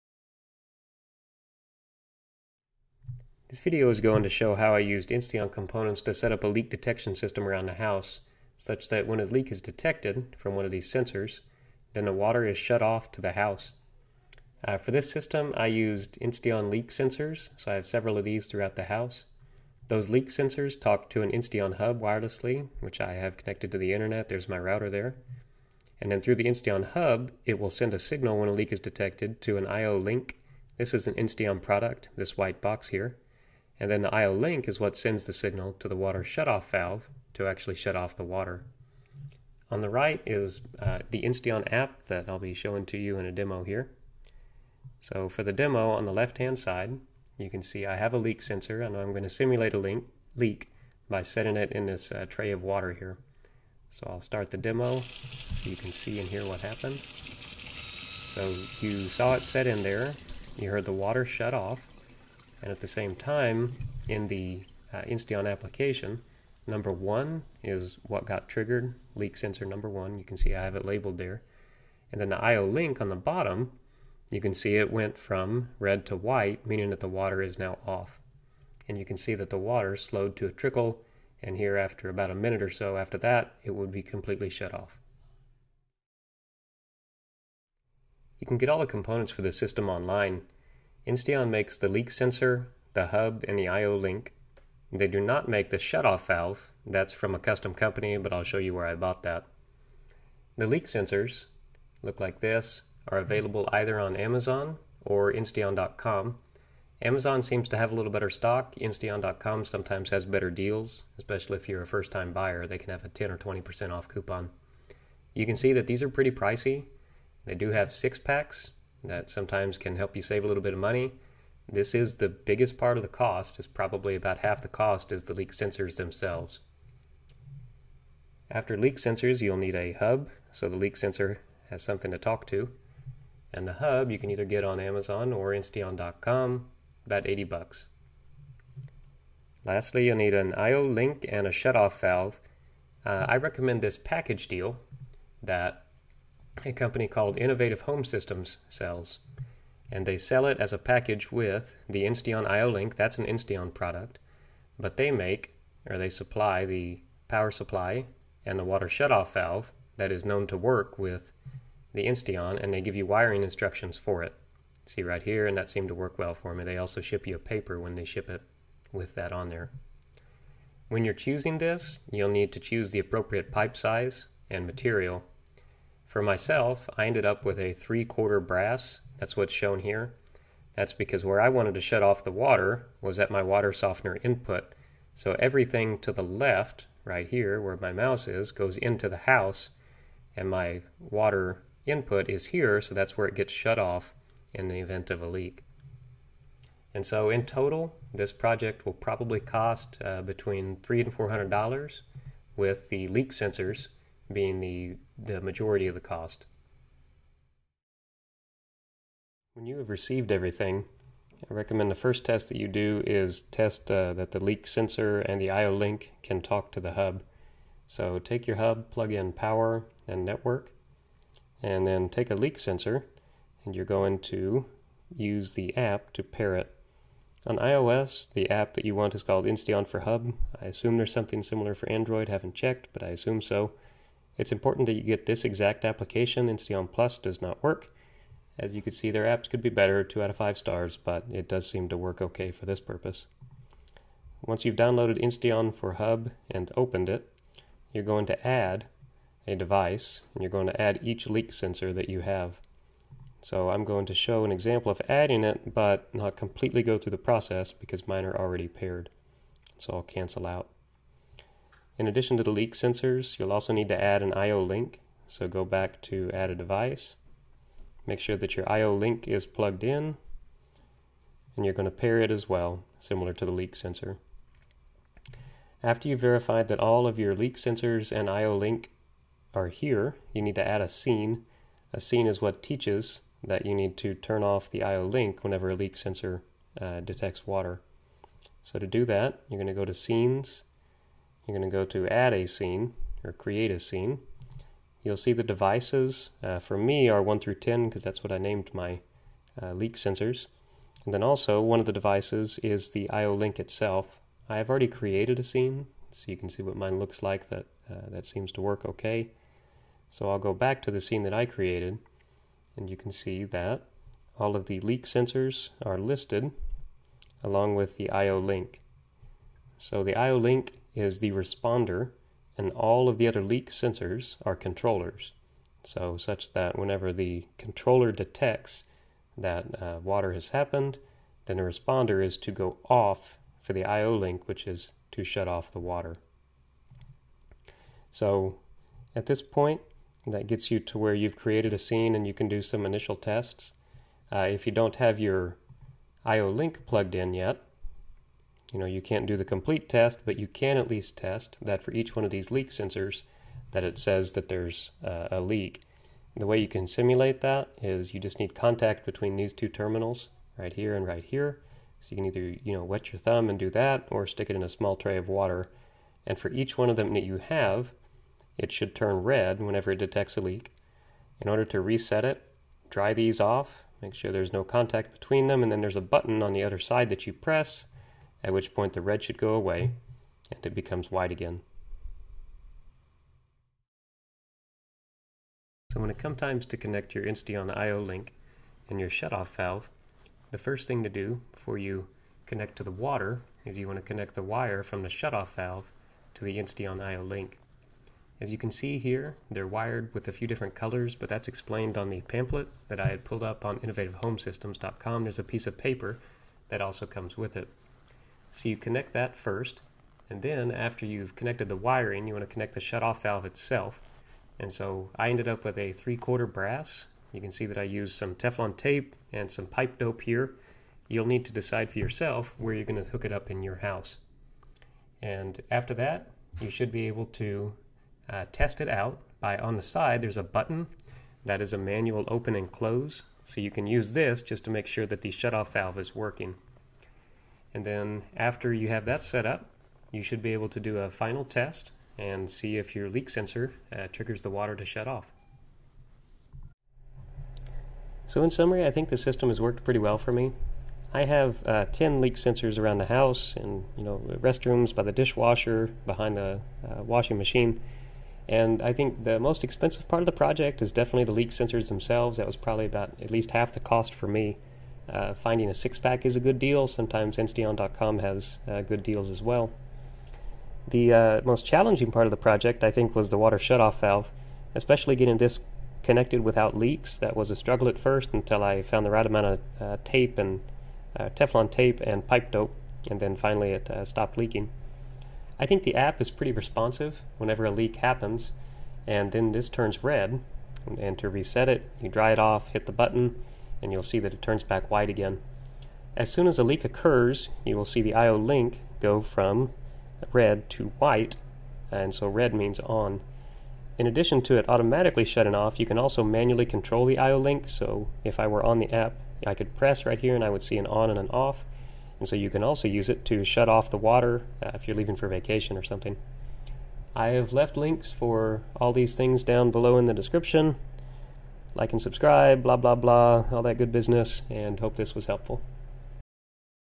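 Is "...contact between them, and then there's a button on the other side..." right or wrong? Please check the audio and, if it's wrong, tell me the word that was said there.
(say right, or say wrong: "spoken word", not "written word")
right.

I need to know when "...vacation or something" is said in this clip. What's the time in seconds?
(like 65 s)
515 s.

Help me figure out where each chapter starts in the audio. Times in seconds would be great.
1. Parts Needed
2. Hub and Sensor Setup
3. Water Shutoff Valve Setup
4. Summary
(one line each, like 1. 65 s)
1. 86 s
2. 208 s
3. 385 s
4. 445 s.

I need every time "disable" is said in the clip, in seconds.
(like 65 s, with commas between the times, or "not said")
not said.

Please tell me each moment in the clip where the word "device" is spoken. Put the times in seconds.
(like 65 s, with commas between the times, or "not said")
249 s, 266 s, 295 s, 301 s.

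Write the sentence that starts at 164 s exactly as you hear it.
See right here, and that seemed to work well for me.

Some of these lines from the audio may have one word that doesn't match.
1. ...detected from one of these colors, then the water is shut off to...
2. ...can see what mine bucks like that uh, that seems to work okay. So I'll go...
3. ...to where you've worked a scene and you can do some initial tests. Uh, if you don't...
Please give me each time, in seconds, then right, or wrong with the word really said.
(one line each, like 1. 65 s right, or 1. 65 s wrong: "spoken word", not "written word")
1. 9 s wrong: "sensors", not "colors"
2. 306 s wrong: "looks", not "bucks"
3. 340 s wrong: "created", not "worked".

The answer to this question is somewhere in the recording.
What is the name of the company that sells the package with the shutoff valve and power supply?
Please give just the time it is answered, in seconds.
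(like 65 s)
147 s.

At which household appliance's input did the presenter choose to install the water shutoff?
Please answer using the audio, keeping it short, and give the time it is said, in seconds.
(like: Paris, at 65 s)
water softener, at 183 s.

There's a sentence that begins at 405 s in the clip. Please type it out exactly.
There's a piece of paper that also comes with it.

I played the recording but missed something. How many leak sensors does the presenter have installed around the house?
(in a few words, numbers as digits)
10.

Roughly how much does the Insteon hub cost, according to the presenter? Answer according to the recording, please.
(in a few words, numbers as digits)
80 bucks.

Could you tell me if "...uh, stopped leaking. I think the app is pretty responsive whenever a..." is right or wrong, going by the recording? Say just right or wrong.
right.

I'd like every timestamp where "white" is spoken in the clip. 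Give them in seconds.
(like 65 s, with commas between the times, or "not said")
32 s, 76 s, 381 s, 494 s, 500 s.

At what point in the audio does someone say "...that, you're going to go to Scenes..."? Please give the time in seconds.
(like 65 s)
289 s.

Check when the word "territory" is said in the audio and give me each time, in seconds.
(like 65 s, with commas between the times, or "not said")
not said.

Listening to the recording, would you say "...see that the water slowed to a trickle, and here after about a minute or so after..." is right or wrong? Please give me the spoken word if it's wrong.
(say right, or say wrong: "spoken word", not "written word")
right.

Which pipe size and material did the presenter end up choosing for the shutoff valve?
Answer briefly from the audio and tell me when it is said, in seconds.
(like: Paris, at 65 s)
three quarter brass, at 177 s.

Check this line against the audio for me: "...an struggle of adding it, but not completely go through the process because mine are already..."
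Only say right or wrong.
wrong.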